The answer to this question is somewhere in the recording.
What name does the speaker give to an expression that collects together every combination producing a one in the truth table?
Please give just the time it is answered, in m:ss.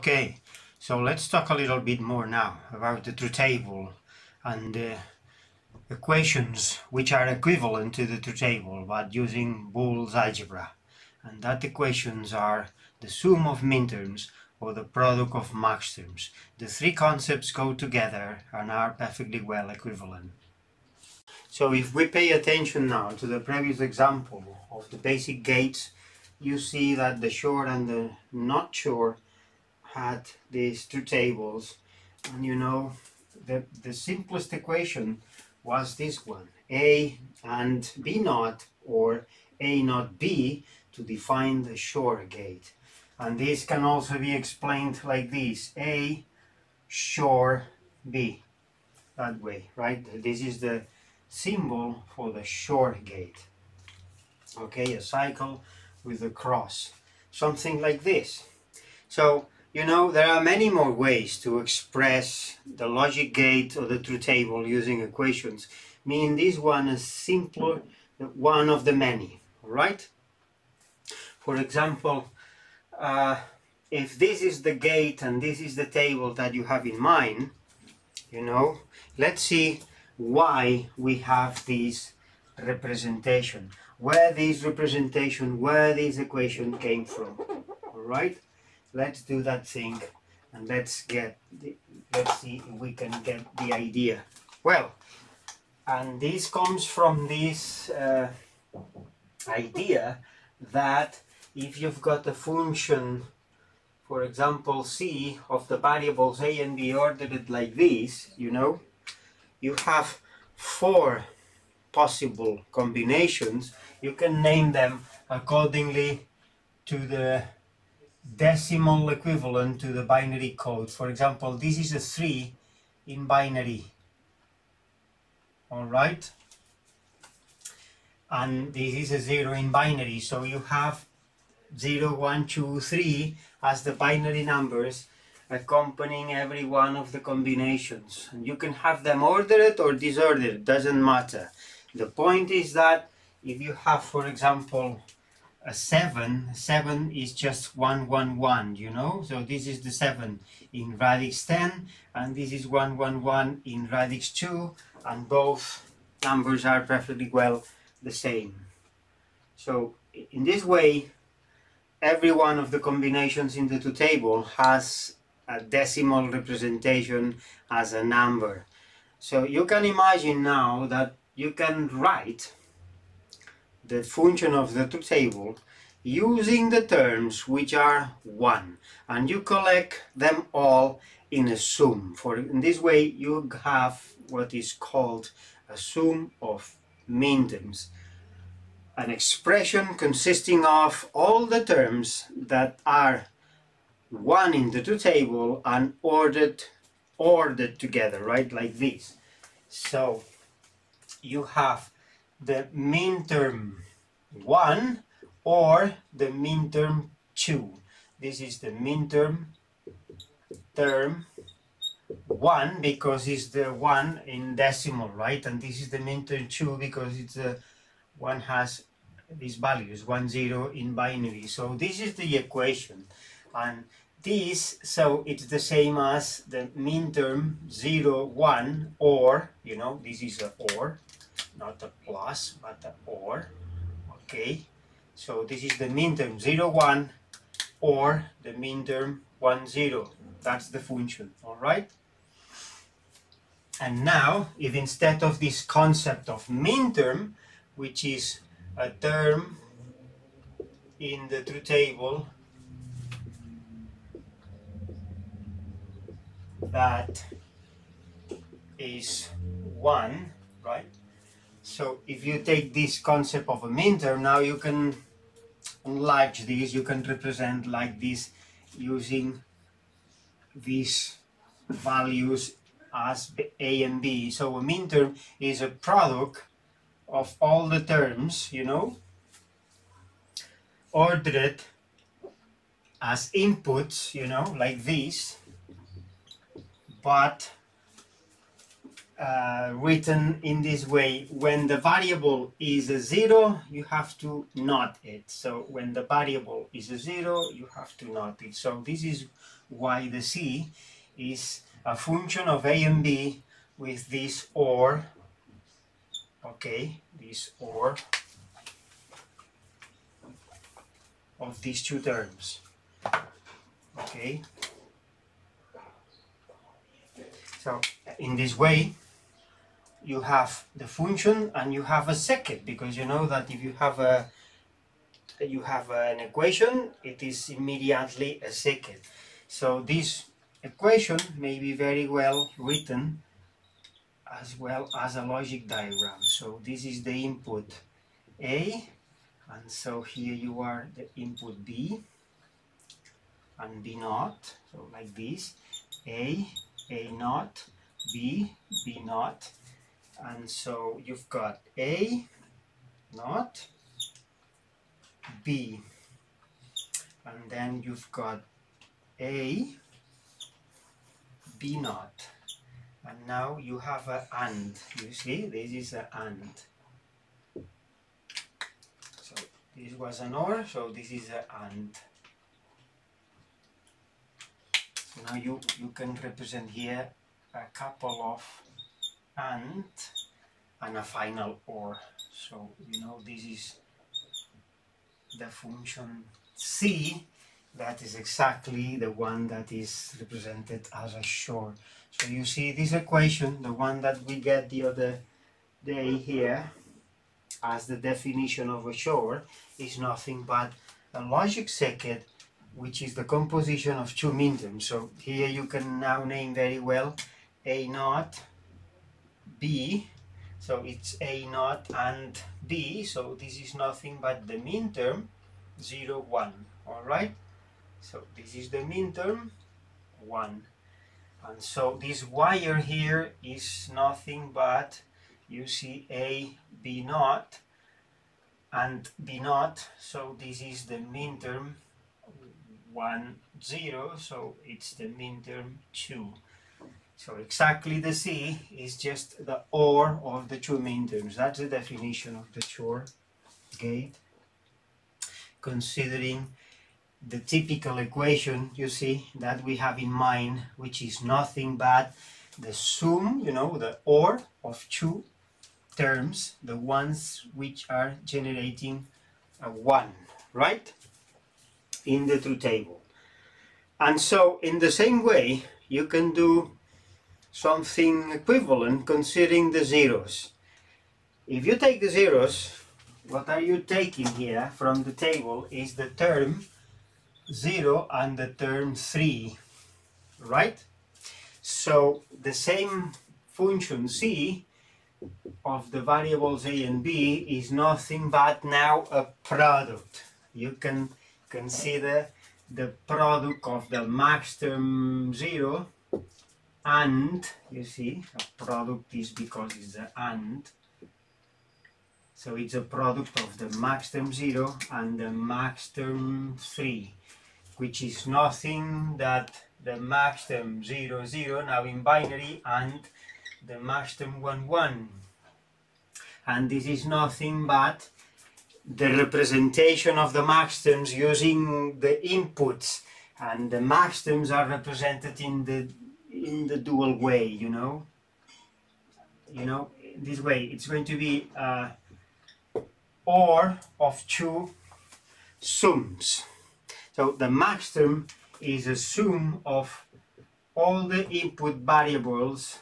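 3:05.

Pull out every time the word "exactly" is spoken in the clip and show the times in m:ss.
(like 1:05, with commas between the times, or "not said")
6:28, 7:17.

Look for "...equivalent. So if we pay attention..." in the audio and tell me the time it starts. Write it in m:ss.
0:19.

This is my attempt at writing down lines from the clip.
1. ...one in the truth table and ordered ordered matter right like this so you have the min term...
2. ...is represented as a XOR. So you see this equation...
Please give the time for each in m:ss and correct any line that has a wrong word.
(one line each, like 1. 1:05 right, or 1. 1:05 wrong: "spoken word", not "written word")
1. 3:14 wrong: "together", not "matter"
2. 6:29 right.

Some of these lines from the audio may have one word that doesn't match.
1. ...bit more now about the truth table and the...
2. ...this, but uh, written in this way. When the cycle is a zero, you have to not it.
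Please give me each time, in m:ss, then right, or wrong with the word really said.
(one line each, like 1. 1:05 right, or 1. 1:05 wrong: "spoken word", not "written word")
1. 0:01 right
2. 4:44 wrong: "variable", not "cycle".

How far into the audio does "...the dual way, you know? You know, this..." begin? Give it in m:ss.
8:46.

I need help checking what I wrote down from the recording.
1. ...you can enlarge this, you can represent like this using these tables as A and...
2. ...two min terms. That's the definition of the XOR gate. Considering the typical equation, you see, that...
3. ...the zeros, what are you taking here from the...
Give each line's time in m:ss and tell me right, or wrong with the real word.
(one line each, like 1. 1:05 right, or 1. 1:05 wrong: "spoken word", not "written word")
1. 4:24 wrong: "values", not "tables"
2. 7:20 right
3. 7:52 right.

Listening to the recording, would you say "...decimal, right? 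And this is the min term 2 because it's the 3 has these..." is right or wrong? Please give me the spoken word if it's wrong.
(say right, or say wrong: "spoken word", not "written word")
wrong: "1", not "3".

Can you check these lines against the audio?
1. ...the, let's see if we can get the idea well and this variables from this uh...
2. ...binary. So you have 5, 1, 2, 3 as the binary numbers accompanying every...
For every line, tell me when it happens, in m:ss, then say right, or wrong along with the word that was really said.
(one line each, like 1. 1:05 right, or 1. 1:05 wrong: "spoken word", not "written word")
1. 1:31 wrong: "comes", not "variables"
2. 2:09 wrong: "0", not "5".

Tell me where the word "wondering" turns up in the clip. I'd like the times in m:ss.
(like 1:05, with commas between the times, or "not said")
not said.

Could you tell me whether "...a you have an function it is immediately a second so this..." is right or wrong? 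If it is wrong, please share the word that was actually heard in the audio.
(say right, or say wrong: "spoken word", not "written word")
wrong: "equation", not "function".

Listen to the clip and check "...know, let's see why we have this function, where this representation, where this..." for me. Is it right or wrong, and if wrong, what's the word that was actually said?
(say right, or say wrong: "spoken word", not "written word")
wrong: "representation", not "function".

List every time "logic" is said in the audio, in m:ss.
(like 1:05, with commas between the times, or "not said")
1:02, 5:35, 6:41.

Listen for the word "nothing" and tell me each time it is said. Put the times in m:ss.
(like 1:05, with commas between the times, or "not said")
6:39, 6:53, 7:03, 7:31, 8:07, 8:28, 8:37.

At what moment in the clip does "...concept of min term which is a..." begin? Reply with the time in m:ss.
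4:05.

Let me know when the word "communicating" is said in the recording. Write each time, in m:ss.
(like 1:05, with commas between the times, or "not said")
not said.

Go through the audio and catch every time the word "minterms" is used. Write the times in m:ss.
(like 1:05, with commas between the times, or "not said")
0:13, 4:23, 6:44.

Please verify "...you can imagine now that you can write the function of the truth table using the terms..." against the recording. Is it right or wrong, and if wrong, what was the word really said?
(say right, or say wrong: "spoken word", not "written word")
right.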